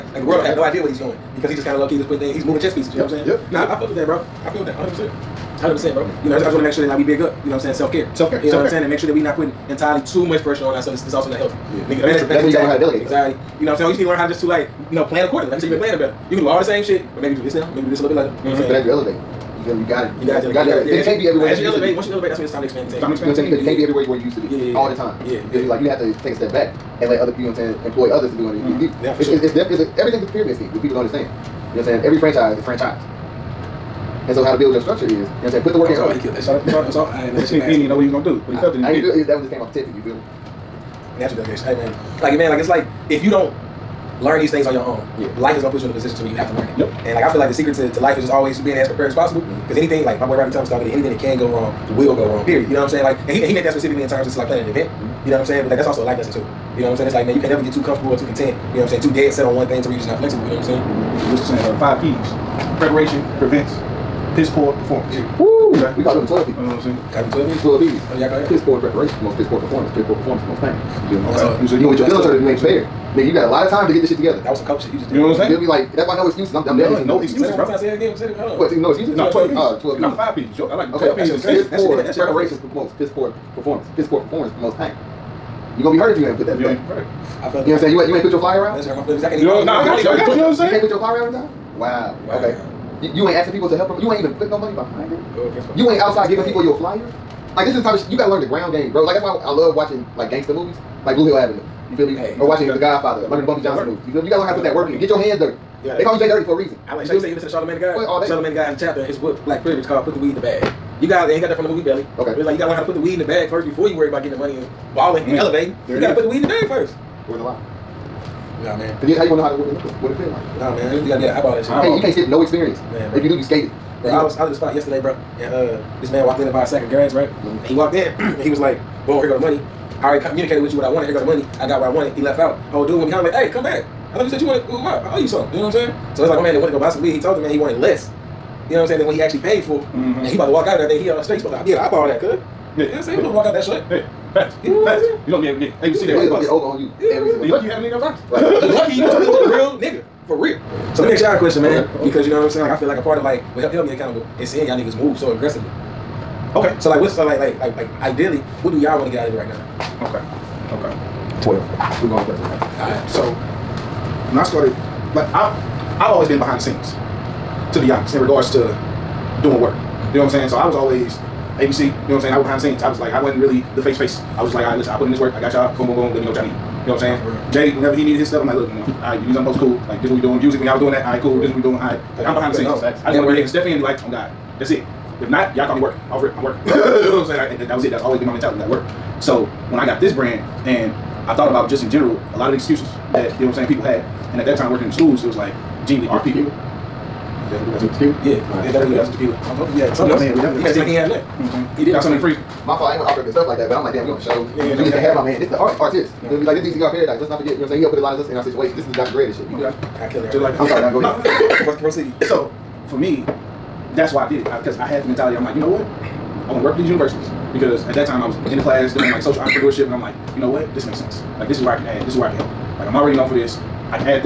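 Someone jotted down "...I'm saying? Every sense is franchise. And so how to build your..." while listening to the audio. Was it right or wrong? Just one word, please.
wrong.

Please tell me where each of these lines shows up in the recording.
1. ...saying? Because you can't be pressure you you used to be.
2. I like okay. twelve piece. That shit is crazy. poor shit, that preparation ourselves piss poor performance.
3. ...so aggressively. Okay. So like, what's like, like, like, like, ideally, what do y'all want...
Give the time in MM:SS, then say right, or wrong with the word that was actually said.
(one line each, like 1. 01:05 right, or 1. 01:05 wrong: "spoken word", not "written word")
1. 00:23 wrong: "everywhere", not "pressure"
2. 01:20 wrong: "promotes", not "ourselves"
3. 02:35 right.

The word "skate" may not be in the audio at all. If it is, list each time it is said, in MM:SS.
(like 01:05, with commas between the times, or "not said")
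02:03.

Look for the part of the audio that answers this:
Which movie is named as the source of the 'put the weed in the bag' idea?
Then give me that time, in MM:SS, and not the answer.
01:51.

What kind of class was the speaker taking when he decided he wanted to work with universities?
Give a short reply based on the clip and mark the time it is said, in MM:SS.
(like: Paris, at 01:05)
social entrepreneurship, at 03:39.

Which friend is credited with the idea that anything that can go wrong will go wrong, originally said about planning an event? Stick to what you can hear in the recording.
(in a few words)
Rodney Thomas.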